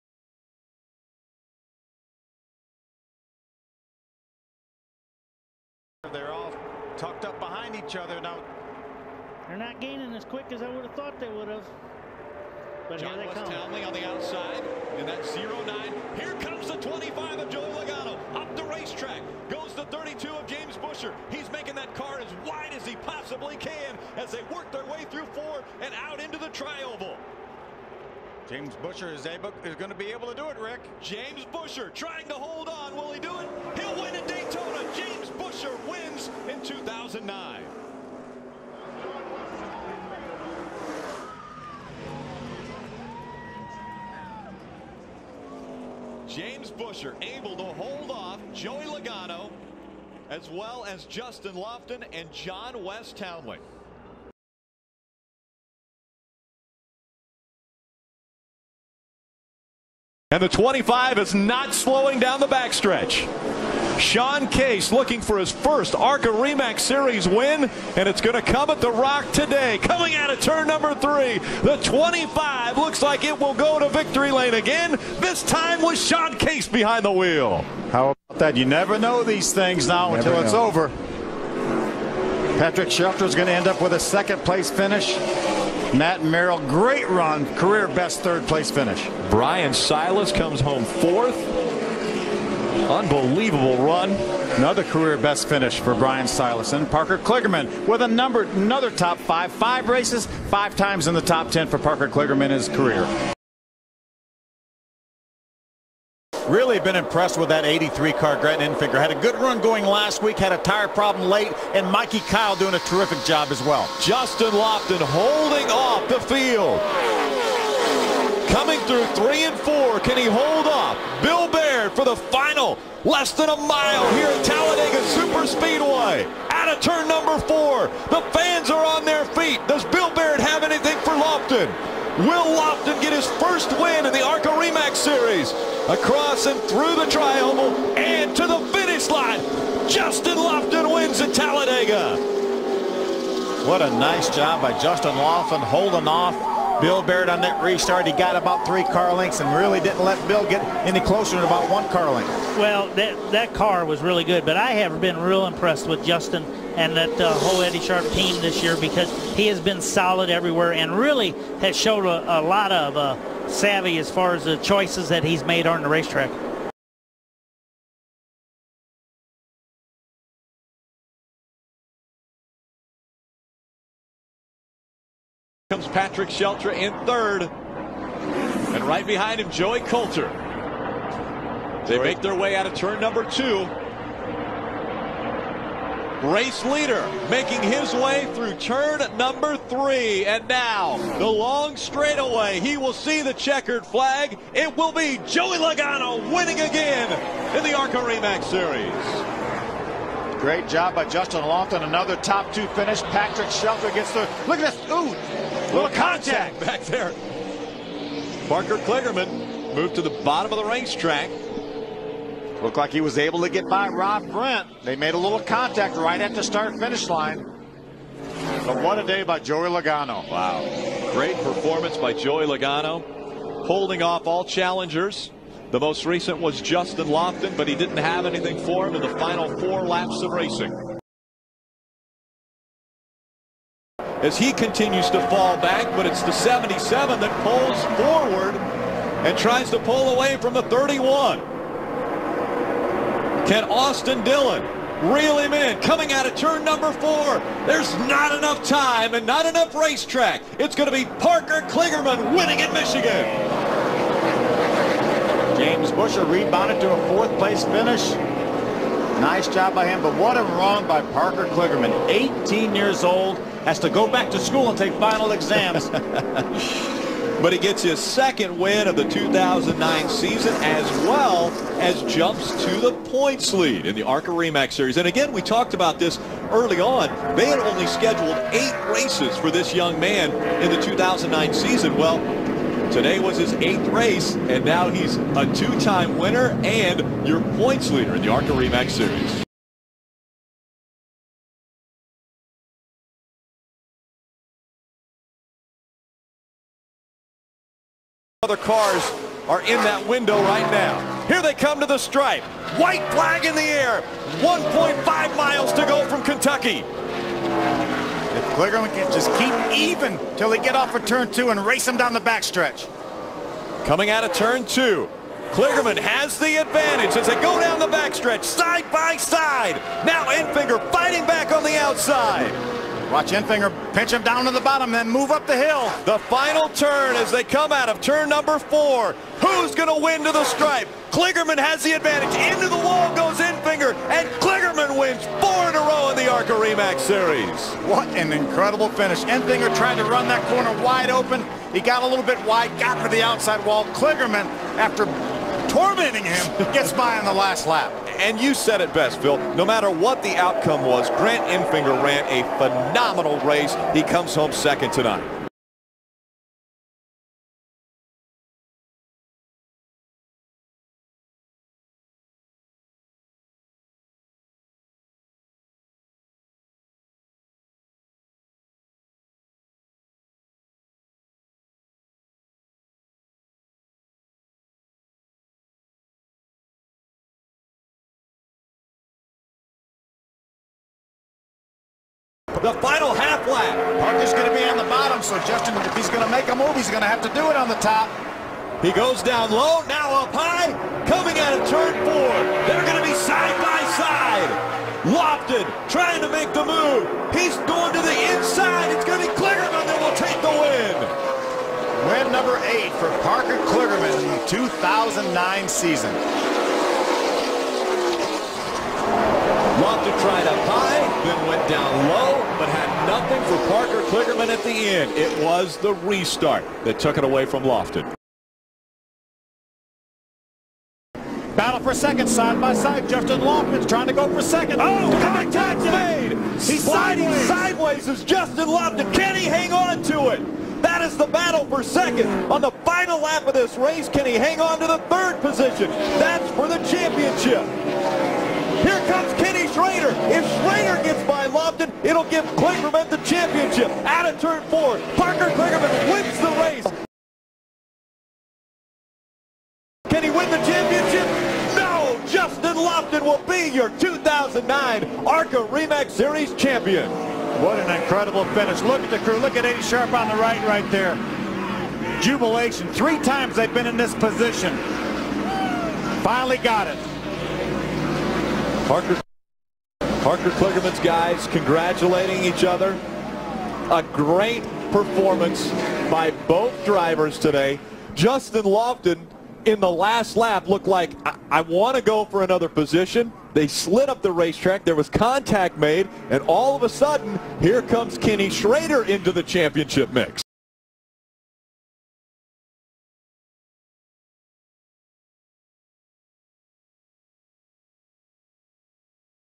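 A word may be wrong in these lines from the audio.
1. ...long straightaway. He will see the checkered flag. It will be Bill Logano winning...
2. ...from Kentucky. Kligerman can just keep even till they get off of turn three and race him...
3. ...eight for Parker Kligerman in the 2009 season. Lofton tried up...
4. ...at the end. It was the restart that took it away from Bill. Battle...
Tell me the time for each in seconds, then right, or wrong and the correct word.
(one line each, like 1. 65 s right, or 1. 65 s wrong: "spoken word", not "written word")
1. 191 s wrong: "Joey", not "Bill"
2. 306 s wrong: "two", not "three"
3. 402 s right
4. 414 s wrong: "Lofton", not "Bill".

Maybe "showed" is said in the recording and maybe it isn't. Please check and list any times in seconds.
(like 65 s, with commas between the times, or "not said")
161 s.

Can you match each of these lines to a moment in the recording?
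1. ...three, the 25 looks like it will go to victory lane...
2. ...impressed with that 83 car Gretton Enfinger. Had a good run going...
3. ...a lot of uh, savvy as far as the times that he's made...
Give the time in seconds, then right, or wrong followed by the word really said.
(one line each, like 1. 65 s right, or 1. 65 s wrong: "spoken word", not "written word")
1. 70 s right
2. 106 s right
3. 162 s wrong: "choices", not "times".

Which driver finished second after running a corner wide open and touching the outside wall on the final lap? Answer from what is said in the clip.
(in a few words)
Grant Enfinger.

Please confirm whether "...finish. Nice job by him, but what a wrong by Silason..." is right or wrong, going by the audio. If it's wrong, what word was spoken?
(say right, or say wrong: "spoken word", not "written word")
wrong: "Parker", not "Silason".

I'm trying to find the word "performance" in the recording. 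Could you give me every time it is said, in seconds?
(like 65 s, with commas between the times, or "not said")
221 s, 474 s.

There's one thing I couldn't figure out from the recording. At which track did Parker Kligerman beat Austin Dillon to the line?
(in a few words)
Michigan.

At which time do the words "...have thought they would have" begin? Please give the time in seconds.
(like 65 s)
10 s.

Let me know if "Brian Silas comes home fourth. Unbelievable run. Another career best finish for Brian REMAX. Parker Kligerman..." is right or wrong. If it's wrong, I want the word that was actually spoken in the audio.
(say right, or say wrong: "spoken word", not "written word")
wrong: "Silason", not "REMAX".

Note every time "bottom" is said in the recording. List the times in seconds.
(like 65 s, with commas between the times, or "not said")
210 s, 324 s, 384 s.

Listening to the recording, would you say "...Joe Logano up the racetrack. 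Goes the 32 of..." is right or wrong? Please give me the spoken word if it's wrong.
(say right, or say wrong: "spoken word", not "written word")
right.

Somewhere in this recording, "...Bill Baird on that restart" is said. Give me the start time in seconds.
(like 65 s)
146 s.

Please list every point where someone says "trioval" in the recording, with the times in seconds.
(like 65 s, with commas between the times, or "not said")
26 s, 137 s.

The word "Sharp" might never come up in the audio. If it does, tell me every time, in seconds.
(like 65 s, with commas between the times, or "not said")
157 s, 459 s.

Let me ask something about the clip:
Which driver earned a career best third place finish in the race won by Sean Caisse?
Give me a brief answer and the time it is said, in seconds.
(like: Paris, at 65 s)
Matt Merrill, at 85 s.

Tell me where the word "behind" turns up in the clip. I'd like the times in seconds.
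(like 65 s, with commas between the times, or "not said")
7 s, 76 s, 179 s.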